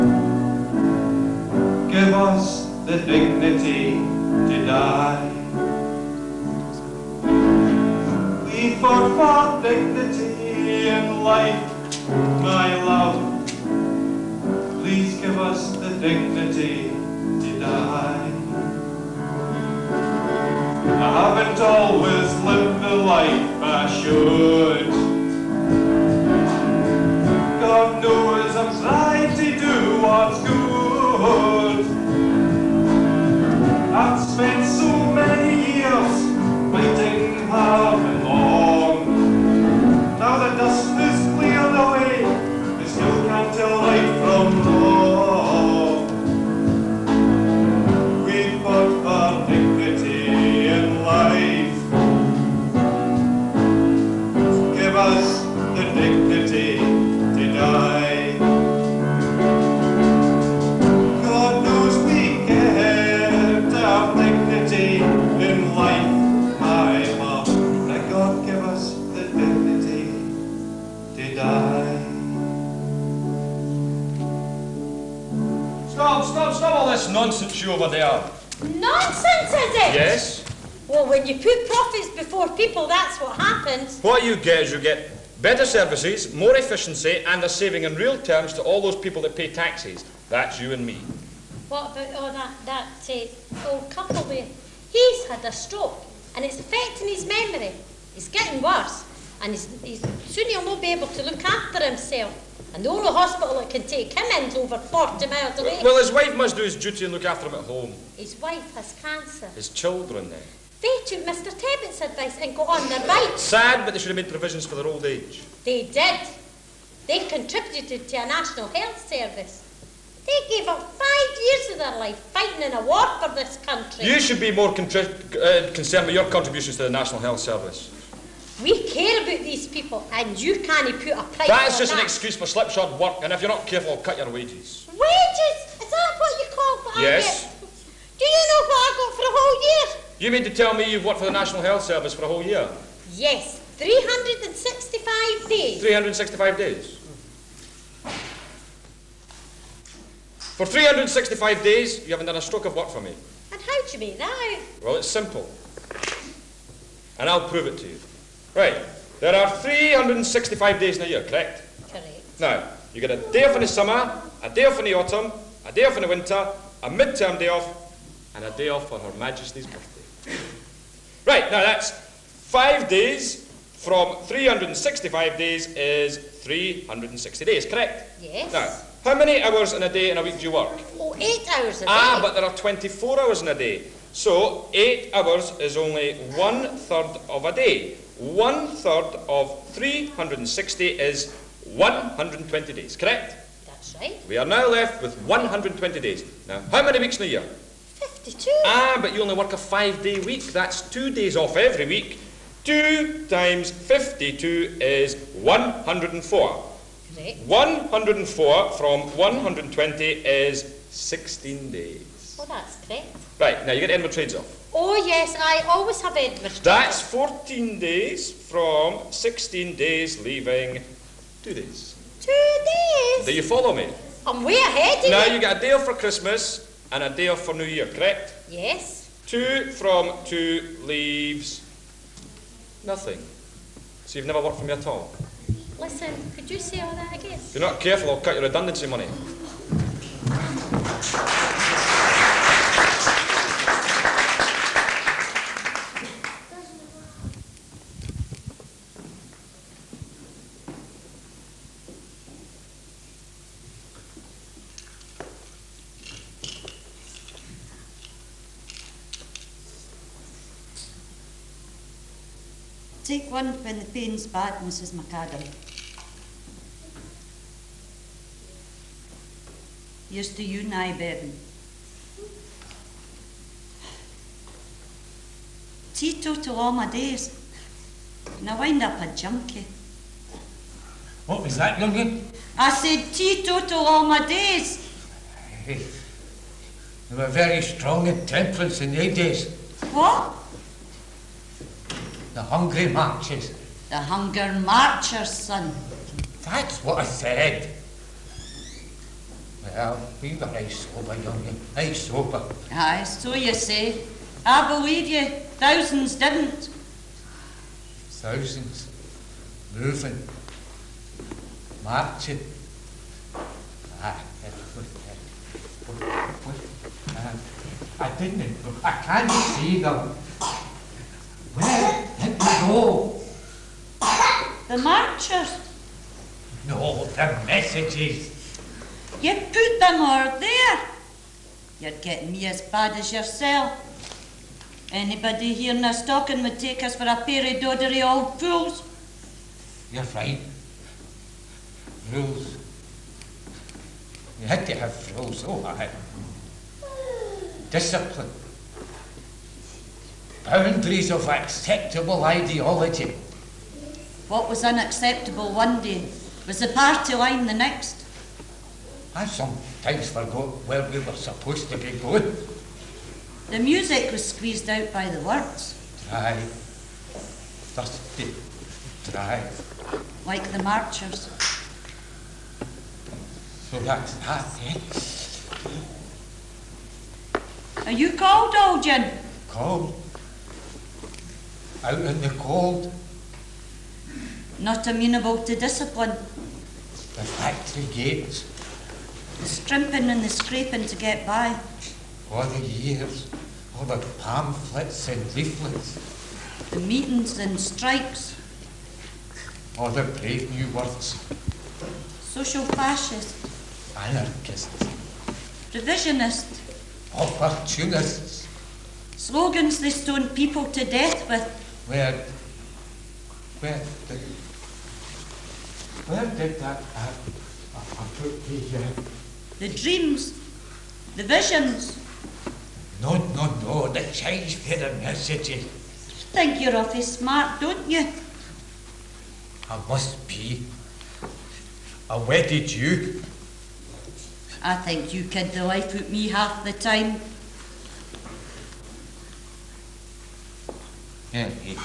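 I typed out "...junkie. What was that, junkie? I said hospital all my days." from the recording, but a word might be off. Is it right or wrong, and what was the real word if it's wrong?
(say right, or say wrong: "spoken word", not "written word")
wrong: "teetotal", not "hospital".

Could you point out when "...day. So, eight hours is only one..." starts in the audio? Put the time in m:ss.
3:03.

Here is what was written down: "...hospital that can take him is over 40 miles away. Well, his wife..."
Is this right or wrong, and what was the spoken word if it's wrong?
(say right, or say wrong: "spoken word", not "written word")
right.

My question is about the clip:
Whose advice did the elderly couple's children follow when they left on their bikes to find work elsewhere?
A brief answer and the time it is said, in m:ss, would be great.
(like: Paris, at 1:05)
Mr Tebbit, at 1:51.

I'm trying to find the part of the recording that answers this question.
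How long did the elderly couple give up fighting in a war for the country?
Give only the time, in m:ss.
2:00.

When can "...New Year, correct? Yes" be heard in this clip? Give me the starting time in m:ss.
3:47.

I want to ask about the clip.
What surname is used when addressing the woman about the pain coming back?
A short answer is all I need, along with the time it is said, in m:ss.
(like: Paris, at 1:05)
McAdam, at 4:24.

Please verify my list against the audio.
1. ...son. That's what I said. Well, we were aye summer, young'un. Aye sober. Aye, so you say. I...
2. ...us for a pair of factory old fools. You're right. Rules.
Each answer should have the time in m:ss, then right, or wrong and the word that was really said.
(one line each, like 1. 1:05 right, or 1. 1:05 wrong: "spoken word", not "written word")
1. 4:55 wrong: "sober", not "summer"
2. 5:36 wrong: "doddery", not "factory".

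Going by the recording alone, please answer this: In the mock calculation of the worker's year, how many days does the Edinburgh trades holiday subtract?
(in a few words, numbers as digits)
14 days.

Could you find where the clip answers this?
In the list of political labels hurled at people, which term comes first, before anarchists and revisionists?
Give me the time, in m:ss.
6:42.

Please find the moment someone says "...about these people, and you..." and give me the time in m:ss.
2:09.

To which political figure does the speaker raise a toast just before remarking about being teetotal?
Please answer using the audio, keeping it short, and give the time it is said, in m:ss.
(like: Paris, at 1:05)
Bevan, at 4:30.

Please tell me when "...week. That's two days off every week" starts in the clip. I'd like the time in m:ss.
3:20.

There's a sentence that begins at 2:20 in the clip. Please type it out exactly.
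You mean to tell me you've worked for the National Health Service for a whole year?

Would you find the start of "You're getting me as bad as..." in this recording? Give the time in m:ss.
5:31.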